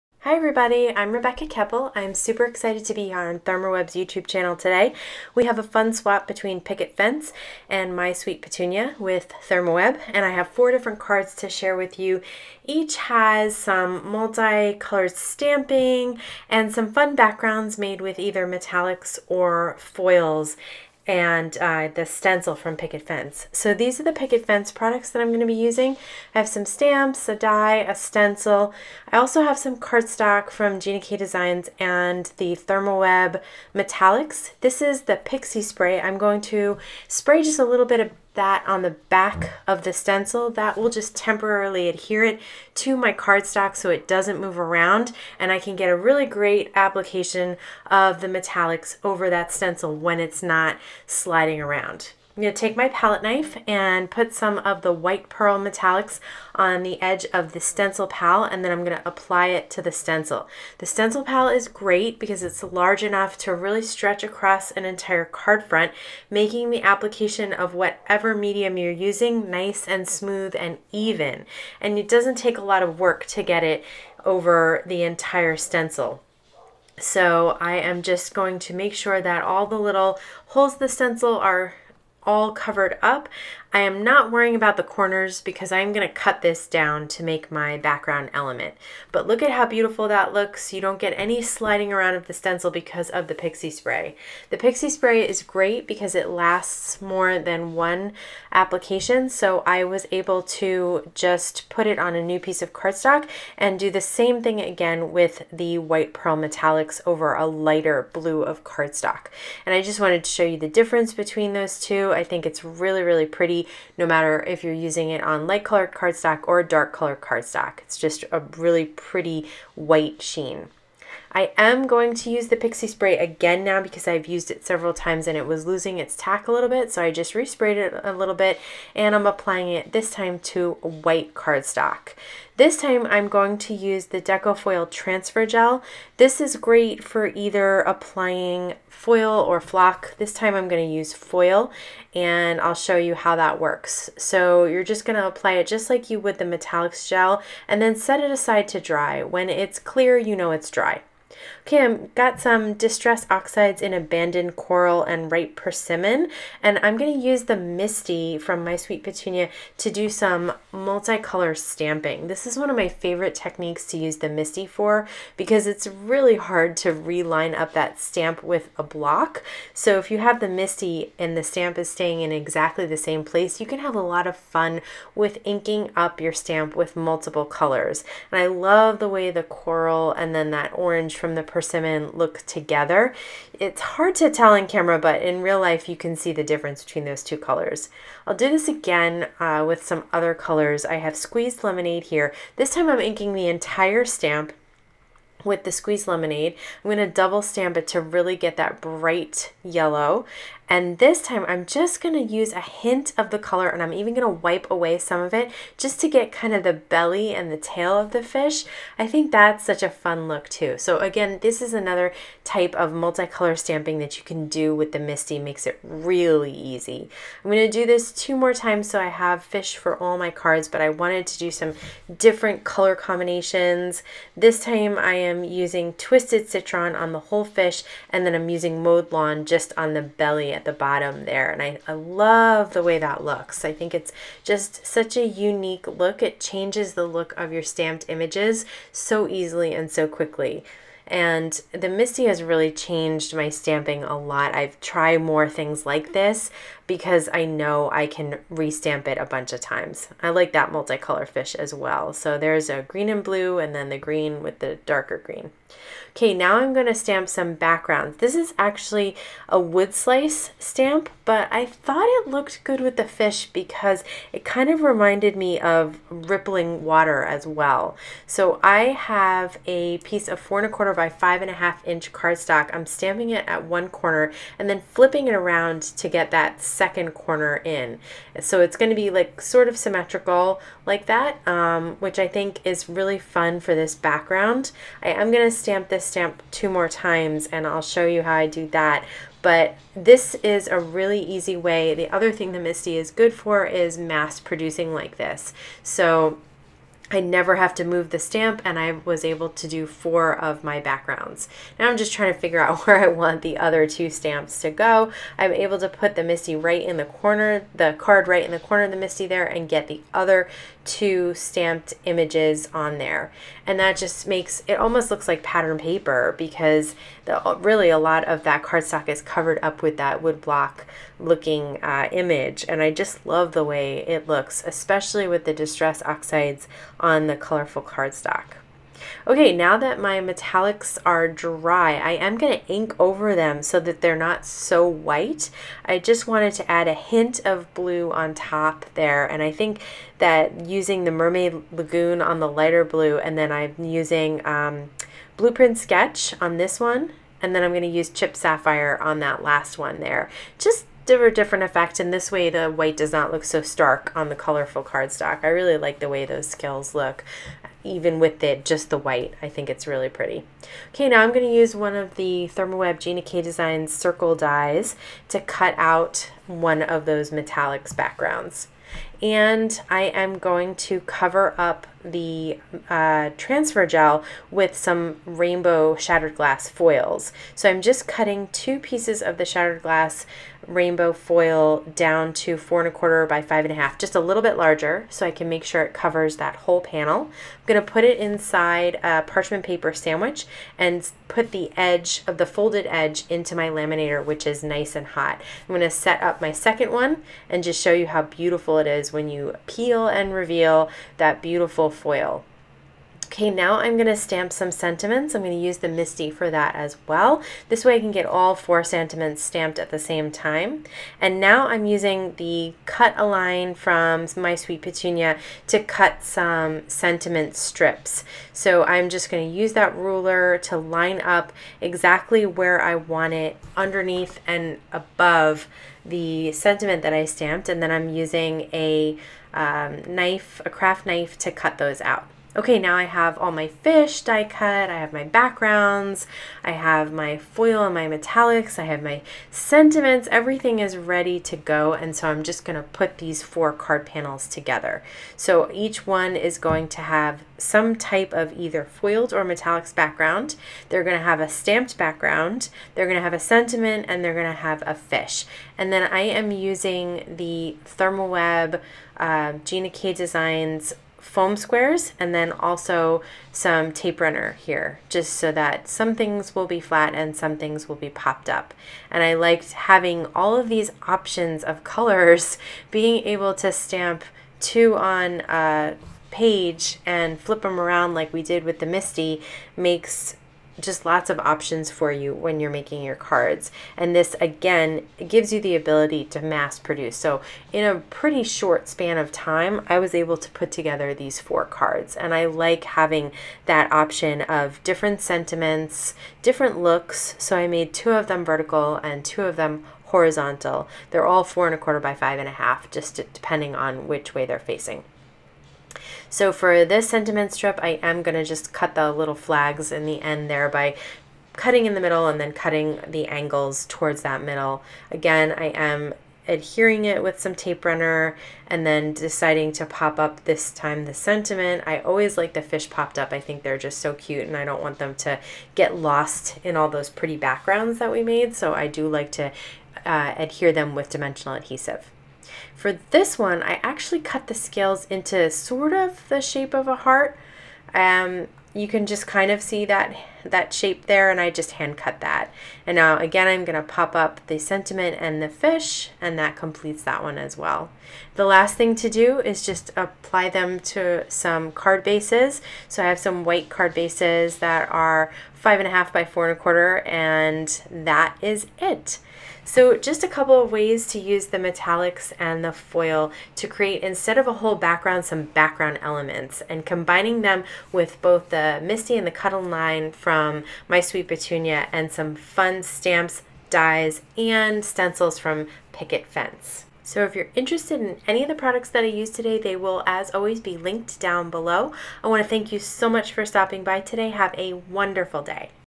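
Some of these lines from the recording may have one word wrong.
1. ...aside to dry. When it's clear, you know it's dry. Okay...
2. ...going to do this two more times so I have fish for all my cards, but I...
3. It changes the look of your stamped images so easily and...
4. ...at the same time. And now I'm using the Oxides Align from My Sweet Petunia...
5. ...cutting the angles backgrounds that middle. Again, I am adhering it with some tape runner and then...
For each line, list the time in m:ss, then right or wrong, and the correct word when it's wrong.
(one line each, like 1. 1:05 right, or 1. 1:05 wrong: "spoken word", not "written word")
1. 2:28 right
2. 3:37 right
3. 3:56 right
4. 6:49 wrong: "Cut", not "Oxides"
5. 8:32 wrong: "towards", not "backgrounds".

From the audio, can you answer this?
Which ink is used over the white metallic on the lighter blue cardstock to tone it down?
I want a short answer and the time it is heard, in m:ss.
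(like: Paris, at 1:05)
Mermaid Lagoon, at 5:41.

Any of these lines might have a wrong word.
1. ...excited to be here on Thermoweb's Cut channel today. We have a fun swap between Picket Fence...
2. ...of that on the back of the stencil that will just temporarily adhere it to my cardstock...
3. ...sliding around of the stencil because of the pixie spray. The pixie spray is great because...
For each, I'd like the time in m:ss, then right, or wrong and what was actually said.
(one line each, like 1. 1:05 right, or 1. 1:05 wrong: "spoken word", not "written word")
1. 0:02 wrong: "YouTube", not "Cut"
2. 0:37 right
3. 1:31 right.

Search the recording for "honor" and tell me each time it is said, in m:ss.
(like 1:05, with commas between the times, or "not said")
not said.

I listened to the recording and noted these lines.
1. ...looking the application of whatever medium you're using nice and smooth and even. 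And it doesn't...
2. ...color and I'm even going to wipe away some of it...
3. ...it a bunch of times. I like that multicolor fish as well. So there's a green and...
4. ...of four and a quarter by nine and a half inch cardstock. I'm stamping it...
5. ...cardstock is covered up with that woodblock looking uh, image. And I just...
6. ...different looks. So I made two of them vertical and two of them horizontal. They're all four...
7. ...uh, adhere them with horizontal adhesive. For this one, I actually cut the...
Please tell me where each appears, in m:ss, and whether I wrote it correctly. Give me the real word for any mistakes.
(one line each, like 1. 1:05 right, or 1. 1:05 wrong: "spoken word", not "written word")
1. 1:06 wrong: "making", not "looking"
2. 3:23 right
3. 4:09 right
4. 4:30 wrong: "five", not "nine"
5. 5:18 right
6. 8:16 right
7. 8:50 wrong: "dimensional", not "horizontal".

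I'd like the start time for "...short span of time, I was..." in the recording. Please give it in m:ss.
8:08.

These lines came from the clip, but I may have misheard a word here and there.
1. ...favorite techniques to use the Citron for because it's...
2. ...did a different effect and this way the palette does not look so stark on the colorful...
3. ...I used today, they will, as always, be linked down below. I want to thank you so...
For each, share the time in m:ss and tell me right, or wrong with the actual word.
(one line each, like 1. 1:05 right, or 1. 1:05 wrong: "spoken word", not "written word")
1. 2:42 wrong: "Misti", not "Citron"
2. 5:51 wrong: "white", not "palette"
3. 9:39 right.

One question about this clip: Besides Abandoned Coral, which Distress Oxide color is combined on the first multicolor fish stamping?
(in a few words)
Ripe Persimmon.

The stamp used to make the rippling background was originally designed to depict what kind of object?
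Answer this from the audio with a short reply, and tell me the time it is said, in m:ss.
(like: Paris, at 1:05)
wood slice, at 4:19.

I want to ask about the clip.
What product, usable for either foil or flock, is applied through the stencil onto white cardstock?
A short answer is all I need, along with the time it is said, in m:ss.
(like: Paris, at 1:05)
Deco Foil Transfer Gel, at 2:14.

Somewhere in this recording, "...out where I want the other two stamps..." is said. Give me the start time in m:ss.
5:02.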